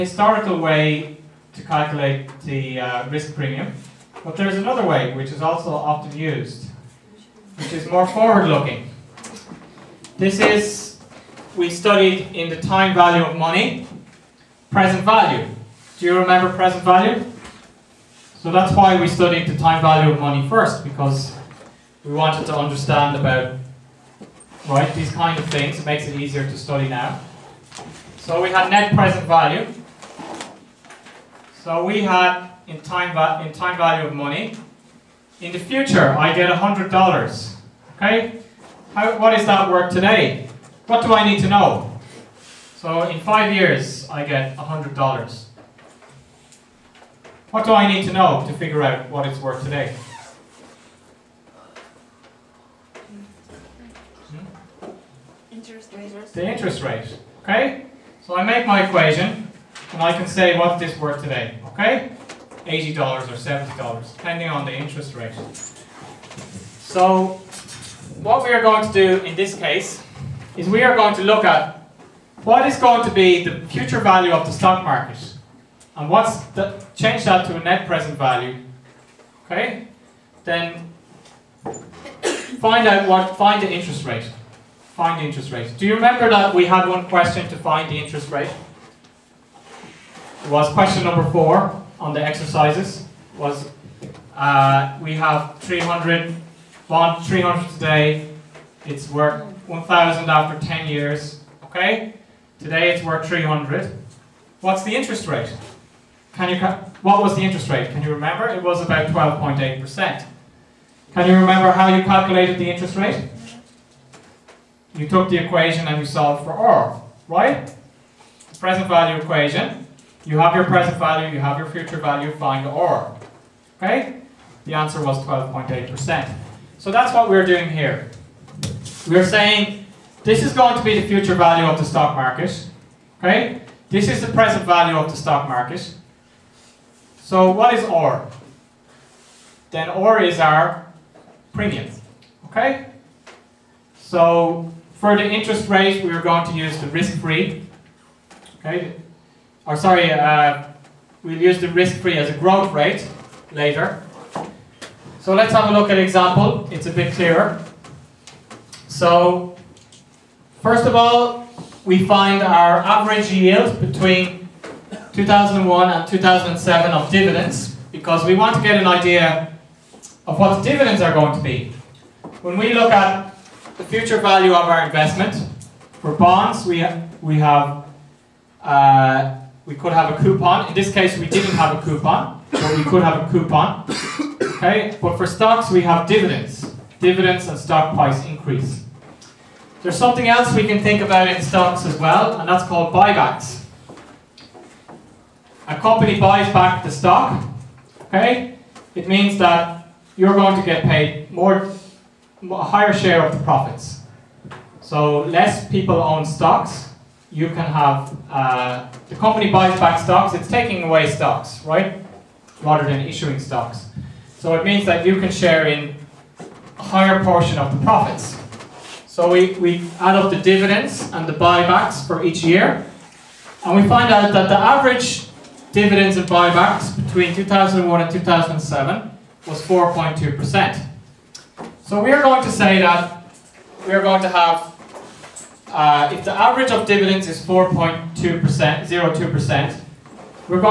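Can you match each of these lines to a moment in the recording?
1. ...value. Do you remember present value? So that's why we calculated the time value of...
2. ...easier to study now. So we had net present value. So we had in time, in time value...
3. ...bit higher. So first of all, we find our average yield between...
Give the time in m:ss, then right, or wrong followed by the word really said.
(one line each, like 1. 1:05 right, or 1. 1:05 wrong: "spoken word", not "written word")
1. 0:15 wrong: "studied", not "calculated"
2. 0:26 right
3. 2:36 wrong: "clearer", not "higher".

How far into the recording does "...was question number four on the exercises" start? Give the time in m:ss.
1:30.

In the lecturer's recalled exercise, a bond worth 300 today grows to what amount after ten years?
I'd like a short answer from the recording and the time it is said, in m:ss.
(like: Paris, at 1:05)
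1,000, at 1:39.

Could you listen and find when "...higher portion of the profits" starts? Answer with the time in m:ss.
3:36.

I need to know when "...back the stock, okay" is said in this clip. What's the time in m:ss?
3:16.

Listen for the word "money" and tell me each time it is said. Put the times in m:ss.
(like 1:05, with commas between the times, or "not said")
0:13, 0:20, 0:34.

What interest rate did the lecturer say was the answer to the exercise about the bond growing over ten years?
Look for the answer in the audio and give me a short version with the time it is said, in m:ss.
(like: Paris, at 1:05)
12.8%, at 1:49.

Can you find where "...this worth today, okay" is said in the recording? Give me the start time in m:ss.
1:00.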